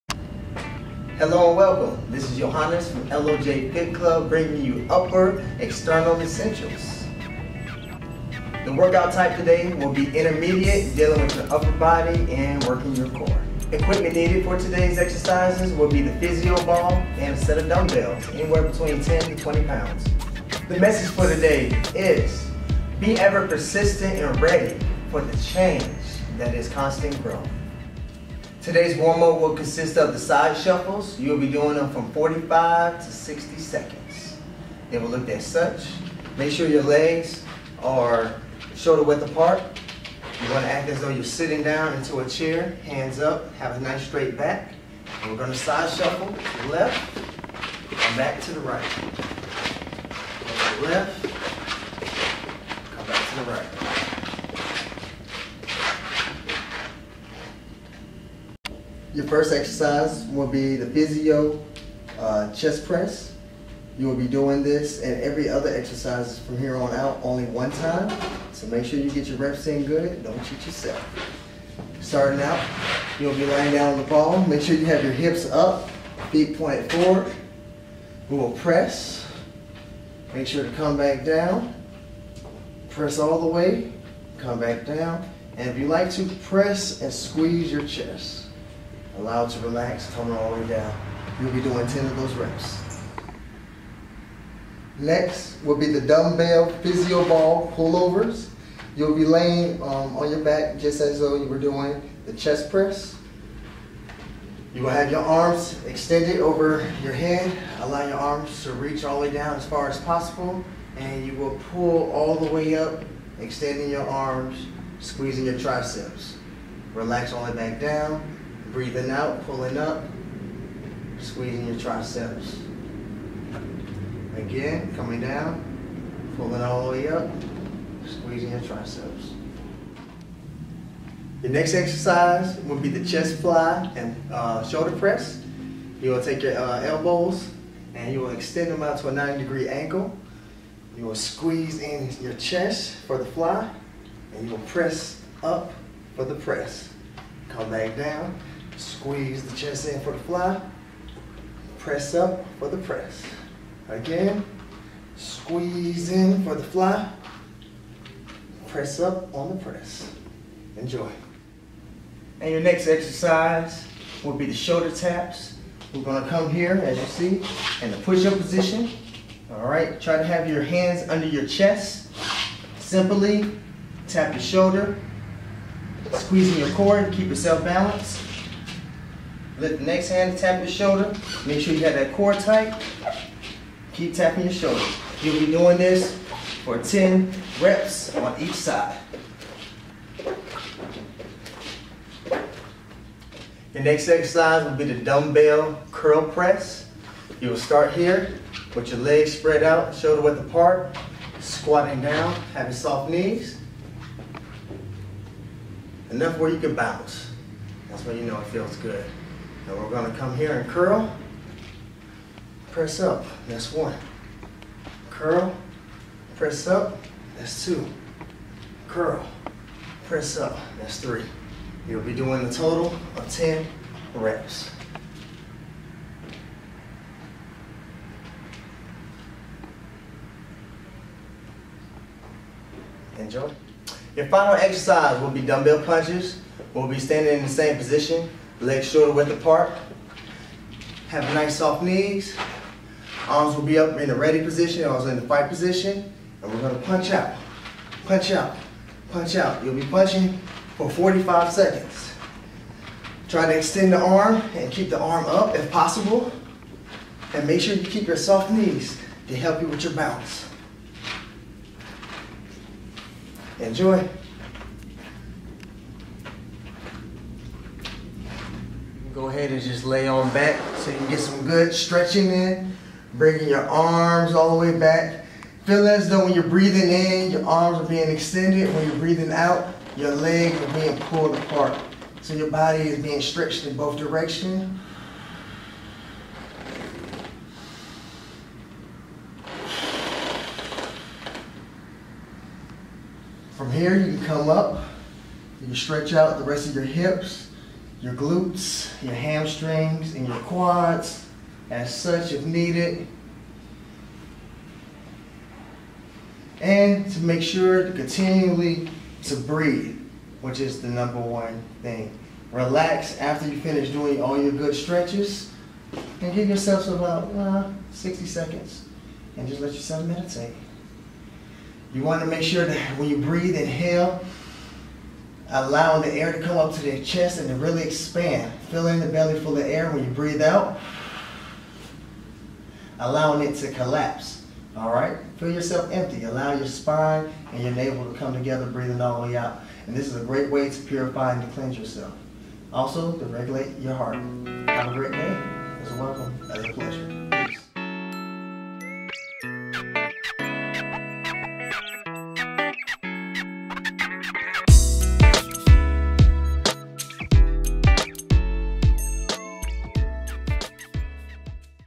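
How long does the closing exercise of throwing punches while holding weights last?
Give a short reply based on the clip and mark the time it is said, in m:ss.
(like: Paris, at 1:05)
45 seconds, at 4:10.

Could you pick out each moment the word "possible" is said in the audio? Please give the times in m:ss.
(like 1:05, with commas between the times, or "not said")
1:50, 4:15.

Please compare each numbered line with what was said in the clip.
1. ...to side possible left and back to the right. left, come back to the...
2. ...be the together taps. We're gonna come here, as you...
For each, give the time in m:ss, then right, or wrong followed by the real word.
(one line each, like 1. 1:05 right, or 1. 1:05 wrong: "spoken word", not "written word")
1. 0:45 wrong: "shuffle", not "possible"
2. 2:44 wrong: "shoulder", not "together".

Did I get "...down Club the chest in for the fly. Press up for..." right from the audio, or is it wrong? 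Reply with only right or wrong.
wrong.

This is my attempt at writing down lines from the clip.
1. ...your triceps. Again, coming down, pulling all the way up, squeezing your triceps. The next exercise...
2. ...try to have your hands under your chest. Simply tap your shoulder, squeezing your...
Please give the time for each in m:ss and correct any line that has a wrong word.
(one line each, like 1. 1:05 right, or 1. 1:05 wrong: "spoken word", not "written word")
1. 2:01 right
2. 2:50 right.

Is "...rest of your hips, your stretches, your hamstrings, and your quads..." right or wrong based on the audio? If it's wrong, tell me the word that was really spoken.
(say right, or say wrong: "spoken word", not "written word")
wrong: "glutes", not "stretches".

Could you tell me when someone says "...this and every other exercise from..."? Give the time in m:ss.
1:04.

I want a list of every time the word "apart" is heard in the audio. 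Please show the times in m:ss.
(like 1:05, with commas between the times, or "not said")
0:39, 3:20, 3:59, 4:41.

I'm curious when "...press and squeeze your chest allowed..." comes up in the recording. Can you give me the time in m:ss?
1:26.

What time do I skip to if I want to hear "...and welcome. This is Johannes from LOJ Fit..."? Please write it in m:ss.
0:01.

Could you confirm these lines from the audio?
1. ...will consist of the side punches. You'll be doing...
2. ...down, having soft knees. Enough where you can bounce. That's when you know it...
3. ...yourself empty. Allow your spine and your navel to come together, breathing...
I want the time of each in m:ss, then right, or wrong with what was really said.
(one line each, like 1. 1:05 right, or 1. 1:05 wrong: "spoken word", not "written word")
1. 0:29 wrong: "shuffles", not "punches"
2. 3:22 right
3. 5:35 right.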